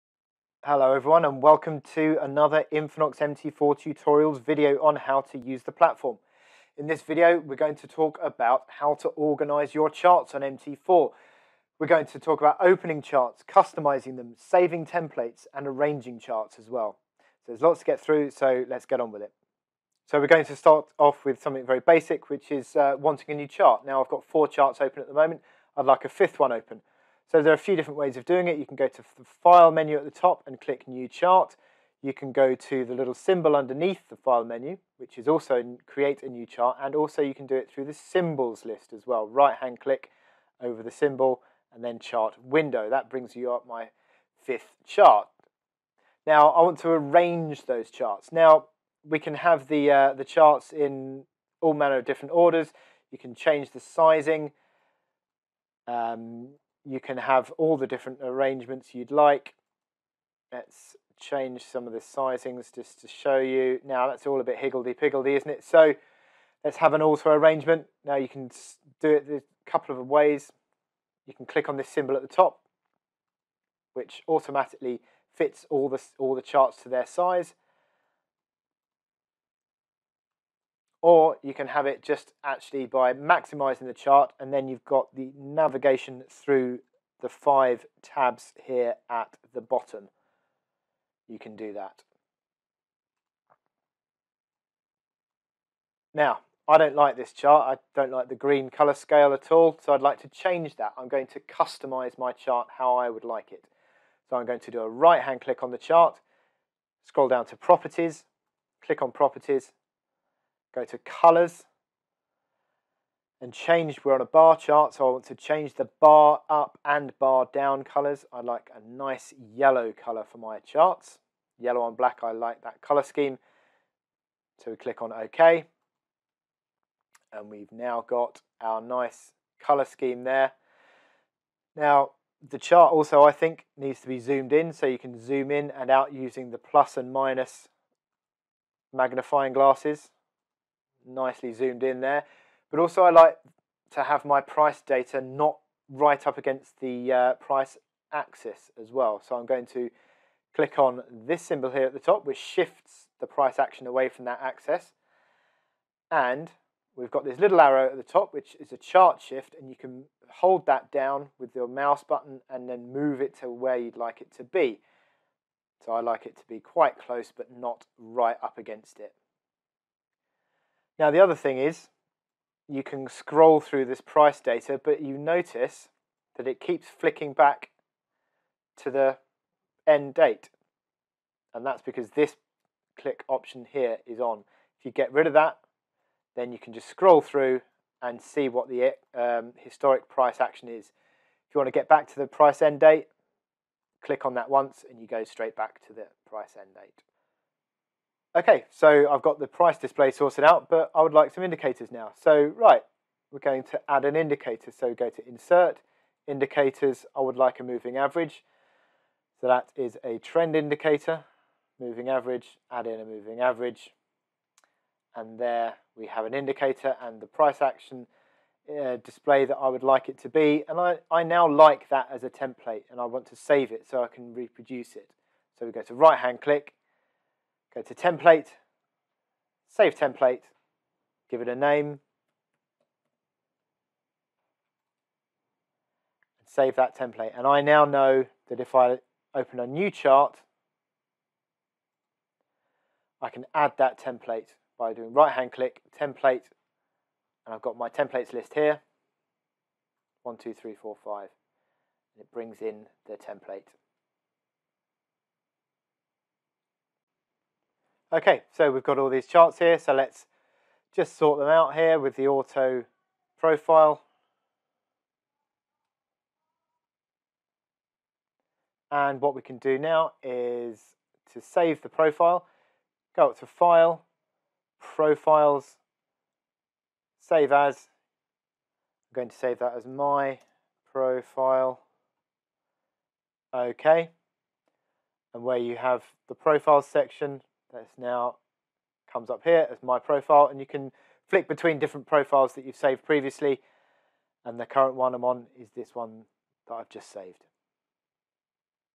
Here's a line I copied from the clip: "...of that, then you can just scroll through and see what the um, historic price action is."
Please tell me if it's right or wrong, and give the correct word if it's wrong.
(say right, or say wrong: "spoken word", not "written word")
right.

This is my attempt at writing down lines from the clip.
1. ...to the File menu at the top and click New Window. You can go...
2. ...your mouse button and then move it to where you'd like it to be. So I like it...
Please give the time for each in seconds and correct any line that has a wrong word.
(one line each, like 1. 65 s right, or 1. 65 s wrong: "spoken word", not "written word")
1. 28 s wrong: "Chart", not "Window"
2. 161 s right.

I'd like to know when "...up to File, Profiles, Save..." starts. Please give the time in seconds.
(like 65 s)
273 s.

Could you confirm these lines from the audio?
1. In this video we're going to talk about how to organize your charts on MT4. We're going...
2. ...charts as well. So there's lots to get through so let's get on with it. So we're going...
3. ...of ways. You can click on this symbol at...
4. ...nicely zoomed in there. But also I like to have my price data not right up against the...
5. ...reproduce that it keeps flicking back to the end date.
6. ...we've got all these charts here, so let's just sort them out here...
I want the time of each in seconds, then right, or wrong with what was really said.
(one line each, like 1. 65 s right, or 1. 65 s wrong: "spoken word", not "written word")
1. 6 s right
2. 16 s right
3. 69 s right
4. 141 s right
5. 175 s wrong: "notice", not "reproduce"
6. 258 s right.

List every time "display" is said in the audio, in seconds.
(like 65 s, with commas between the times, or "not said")
199 s, 219 s.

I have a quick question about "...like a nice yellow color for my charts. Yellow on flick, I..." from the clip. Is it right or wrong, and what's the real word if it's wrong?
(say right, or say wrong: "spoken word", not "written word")
wrong: "black", not "flick".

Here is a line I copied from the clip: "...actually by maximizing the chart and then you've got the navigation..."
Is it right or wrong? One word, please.
right.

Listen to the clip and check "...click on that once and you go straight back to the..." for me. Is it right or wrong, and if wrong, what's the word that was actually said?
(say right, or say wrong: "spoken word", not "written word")
right.